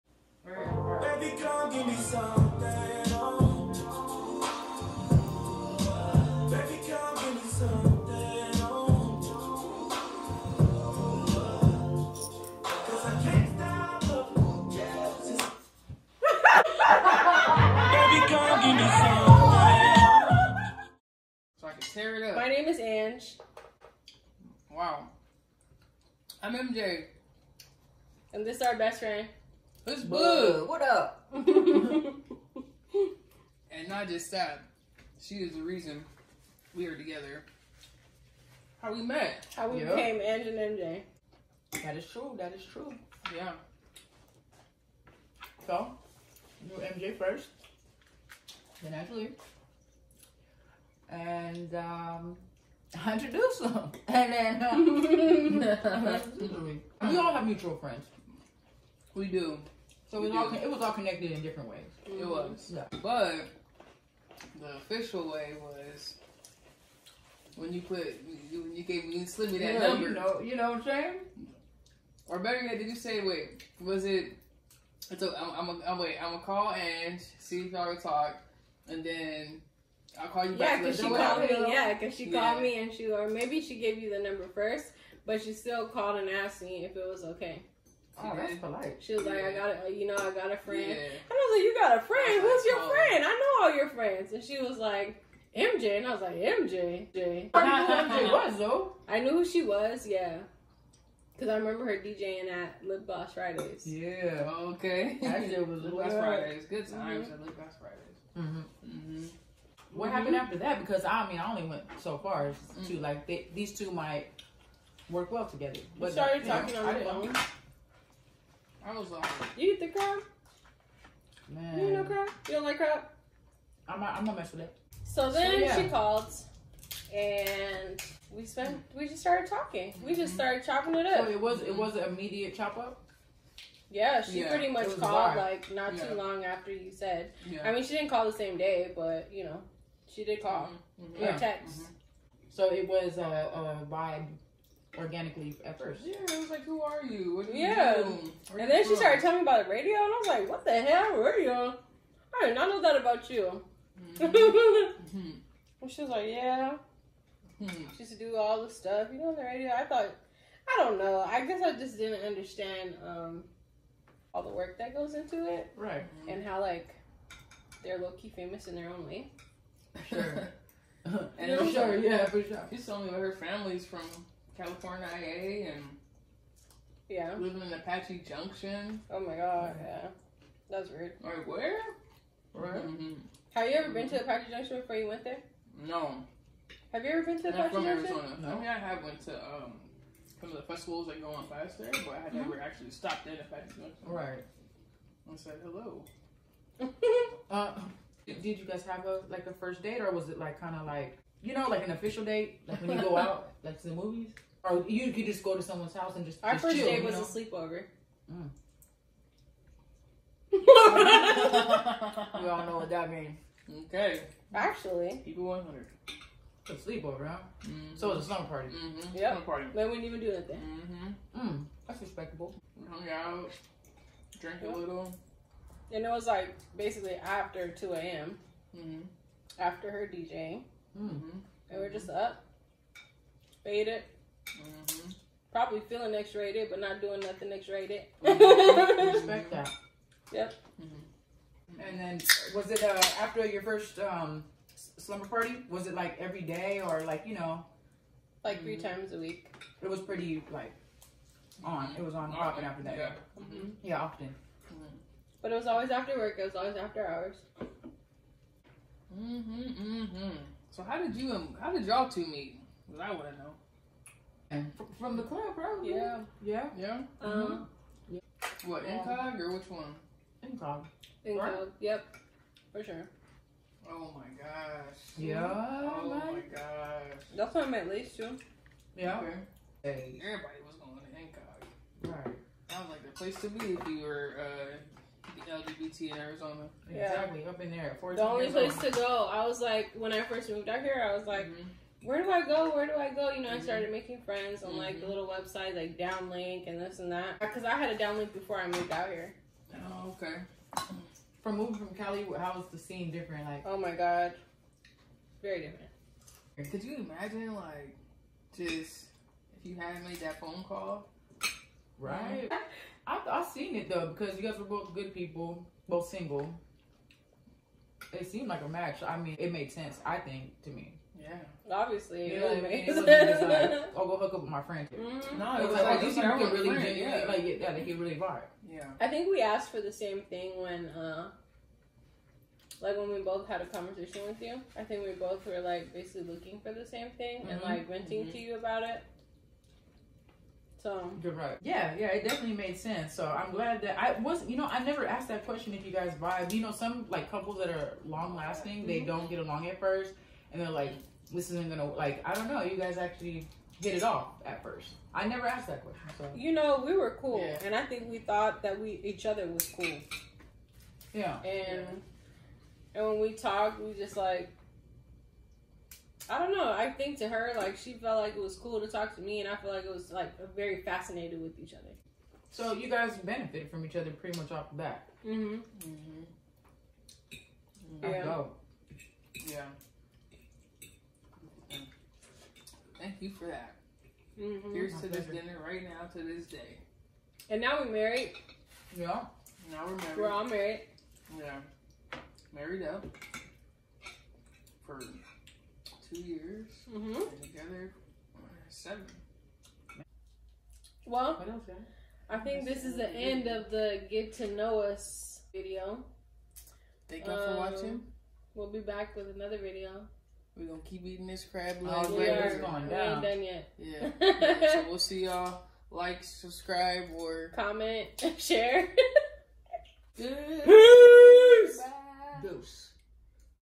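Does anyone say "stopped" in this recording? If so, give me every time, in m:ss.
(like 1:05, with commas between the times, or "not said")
3:12.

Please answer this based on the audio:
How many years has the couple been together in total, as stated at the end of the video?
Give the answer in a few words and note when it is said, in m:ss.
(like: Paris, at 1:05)
7, at 6:38.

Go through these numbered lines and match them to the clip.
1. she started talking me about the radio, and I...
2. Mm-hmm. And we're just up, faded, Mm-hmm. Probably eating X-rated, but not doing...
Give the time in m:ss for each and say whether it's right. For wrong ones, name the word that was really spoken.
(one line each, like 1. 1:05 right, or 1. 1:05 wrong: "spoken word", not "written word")
1. 2:28 wrong: "telling", not "talking"
2. 3:51 wrong: "feeling", not "eating".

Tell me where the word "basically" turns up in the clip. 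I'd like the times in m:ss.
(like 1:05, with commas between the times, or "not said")
3:46, 5:35.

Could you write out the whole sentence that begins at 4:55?
little website, like Downelink and this and that.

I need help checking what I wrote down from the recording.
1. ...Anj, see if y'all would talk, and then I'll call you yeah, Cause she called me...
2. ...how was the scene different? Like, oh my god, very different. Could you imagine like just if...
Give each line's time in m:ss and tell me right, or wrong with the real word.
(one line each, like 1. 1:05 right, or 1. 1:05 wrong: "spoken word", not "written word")
1. 1:16 right
2. 5:02 right.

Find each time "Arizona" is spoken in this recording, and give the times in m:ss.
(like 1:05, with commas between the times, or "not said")
3:08, 4:46.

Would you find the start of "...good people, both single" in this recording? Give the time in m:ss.
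5:14.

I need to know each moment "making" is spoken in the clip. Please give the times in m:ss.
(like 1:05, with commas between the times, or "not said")
4:53.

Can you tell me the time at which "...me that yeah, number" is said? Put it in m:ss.
1:09.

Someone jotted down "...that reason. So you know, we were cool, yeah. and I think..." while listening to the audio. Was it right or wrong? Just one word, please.
wrong.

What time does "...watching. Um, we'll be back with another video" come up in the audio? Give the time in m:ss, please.
6:47.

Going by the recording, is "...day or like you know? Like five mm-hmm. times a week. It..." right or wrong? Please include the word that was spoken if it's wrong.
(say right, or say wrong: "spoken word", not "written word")
wrong: "three", not "five".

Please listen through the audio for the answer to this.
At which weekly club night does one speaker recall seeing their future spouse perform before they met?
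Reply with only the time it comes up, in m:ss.
1:45.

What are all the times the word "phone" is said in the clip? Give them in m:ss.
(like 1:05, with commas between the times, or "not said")
1:57, 5:10.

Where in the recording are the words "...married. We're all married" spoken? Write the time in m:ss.
6:29.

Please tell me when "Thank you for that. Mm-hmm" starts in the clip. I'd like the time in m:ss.
6:23.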